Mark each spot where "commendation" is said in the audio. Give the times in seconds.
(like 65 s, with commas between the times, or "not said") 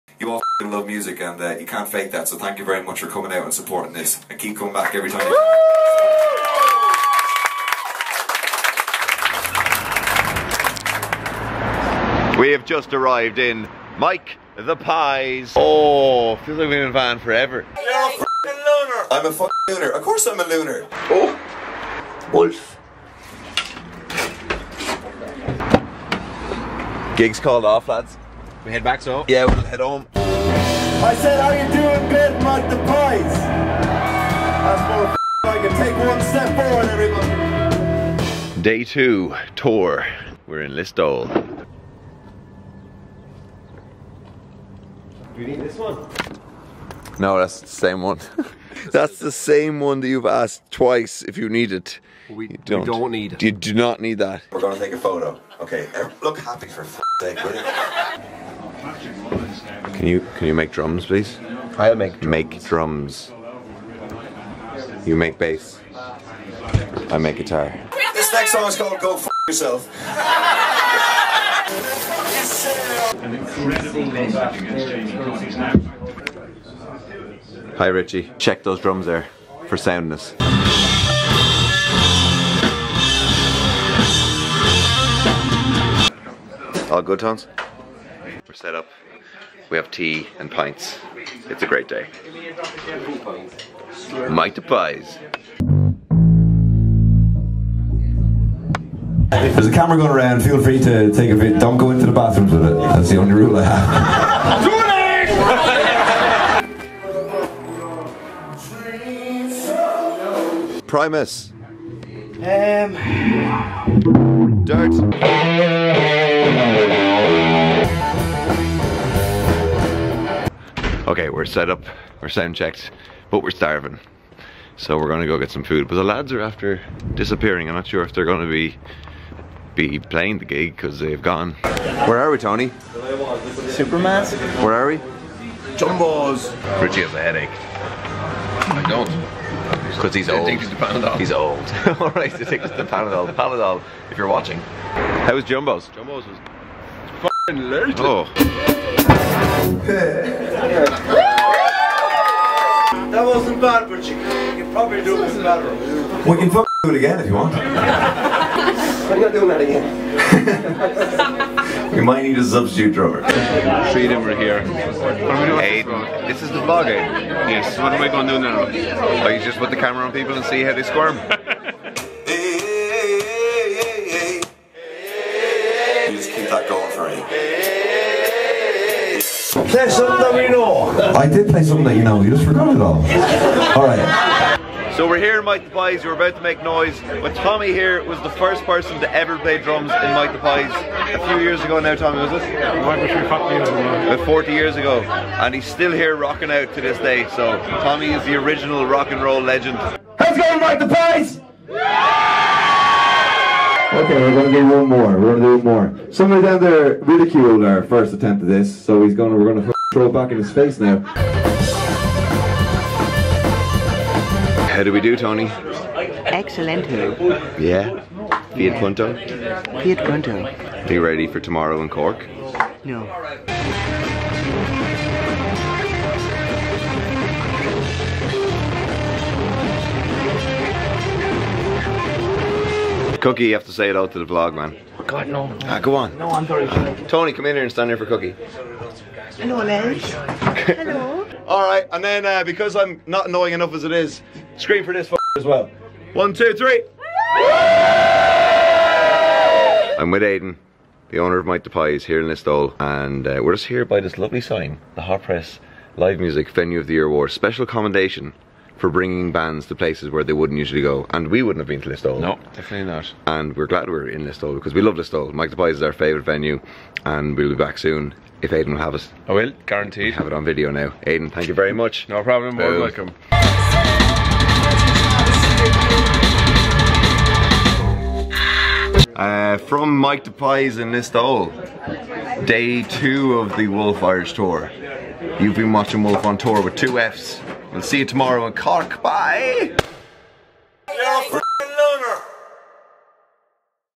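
257 s.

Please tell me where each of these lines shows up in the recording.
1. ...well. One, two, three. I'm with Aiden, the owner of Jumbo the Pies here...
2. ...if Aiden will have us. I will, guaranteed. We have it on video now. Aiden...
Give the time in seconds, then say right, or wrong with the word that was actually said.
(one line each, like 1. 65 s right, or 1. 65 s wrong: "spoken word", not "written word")
1. 245 s wrong: "Mike", not "Jumbo"
2. 268 s right.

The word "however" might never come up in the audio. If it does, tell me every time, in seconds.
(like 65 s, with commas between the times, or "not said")
not said.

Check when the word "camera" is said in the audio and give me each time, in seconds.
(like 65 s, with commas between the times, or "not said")
99 s, 169 s.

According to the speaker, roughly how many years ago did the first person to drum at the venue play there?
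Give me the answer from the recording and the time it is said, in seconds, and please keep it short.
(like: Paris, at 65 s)
40, at 192 s.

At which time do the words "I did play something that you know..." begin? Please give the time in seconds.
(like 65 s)
181 s.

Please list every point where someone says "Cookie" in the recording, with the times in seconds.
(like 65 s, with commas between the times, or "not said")
233 s, 238 s.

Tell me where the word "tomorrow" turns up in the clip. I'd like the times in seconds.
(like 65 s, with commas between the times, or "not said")
221 s, 288 s.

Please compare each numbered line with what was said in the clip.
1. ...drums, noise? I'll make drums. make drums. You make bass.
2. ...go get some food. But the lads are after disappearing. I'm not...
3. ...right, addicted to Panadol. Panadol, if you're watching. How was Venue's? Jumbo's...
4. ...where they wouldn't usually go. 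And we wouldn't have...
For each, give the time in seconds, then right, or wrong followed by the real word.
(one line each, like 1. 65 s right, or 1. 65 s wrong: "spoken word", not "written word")
1. 60 s wrong: "please", not "noise"
2. 125 s right
3. 142 s wrong: "Jumbo", not "Venue"
4. 260 s right.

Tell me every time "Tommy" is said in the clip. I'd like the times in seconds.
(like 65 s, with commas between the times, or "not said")
187 s, 191 s, 197 s.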